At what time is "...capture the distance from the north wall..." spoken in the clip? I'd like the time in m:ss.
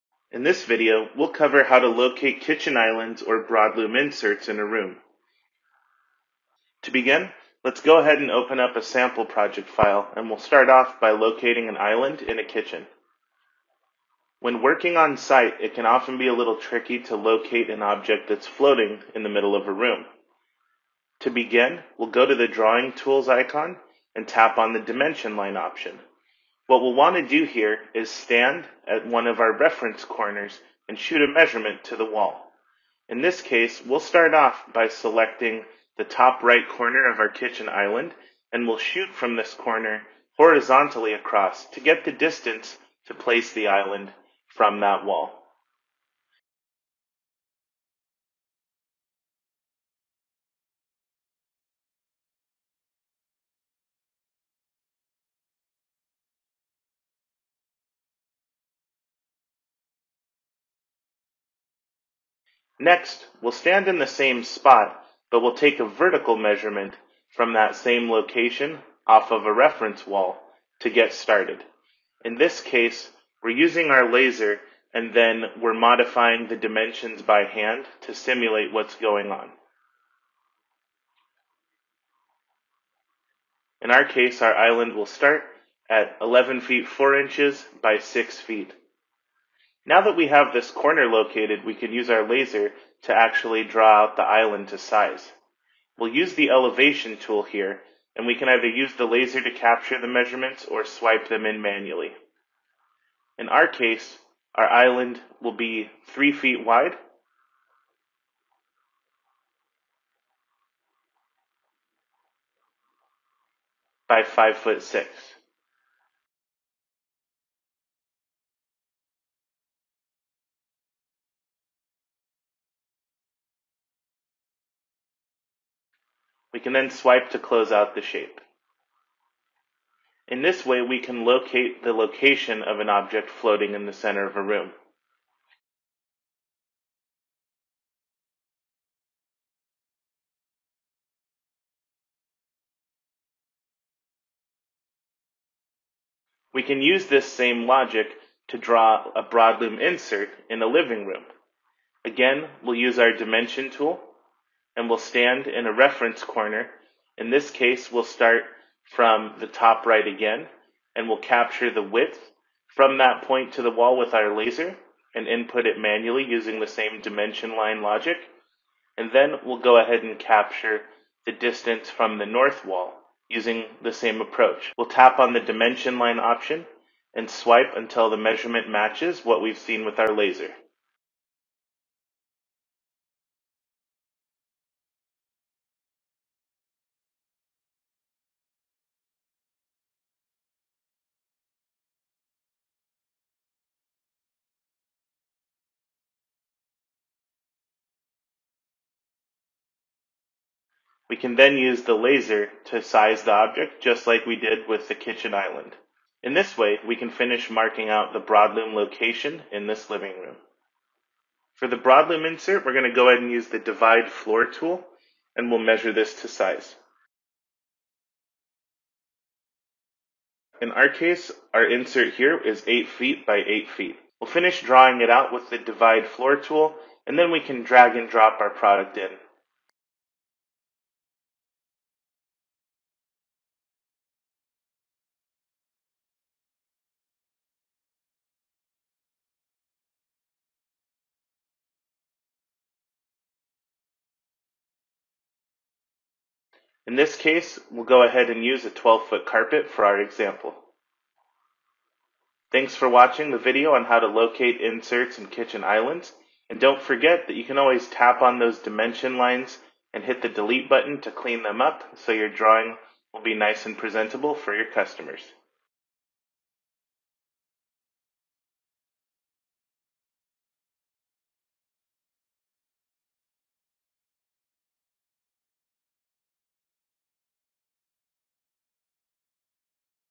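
2:50.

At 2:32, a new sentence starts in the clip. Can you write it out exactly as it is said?
Again, we'll use our dimension tool and we'll stand in a reference corner.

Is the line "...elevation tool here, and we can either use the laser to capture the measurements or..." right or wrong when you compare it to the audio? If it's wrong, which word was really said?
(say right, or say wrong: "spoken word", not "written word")
right.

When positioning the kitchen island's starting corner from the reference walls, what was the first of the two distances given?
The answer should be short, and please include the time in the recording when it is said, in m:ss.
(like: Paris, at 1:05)
11 feet 4 inches, at 1:26.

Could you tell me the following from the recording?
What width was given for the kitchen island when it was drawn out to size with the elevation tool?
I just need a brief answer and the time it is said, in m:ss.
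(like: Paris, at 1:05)
3 feet, at 1:46.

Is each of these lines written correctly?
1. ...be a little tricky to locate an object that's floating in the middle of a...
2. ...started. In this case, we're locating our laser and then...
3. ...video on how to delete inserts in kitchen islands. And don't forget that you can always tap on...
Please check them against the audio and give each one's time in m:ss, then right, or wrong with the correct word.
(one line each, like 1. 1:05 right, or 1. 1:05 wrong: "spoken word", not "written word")
1. 0:16 right
2. 1:11 wrong: "using", not "locating"
3. 4:13 wrong: "locate", not "delete".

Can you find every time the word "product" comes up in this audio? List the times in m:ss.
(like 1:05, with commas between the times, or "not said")
3:48.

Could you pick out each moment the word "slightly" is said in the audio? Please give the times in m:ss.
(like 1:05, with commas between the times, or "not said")
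not said.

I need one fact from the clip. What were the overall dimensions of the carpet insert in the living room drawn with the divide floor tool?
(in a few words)
8 feet by 8 feet.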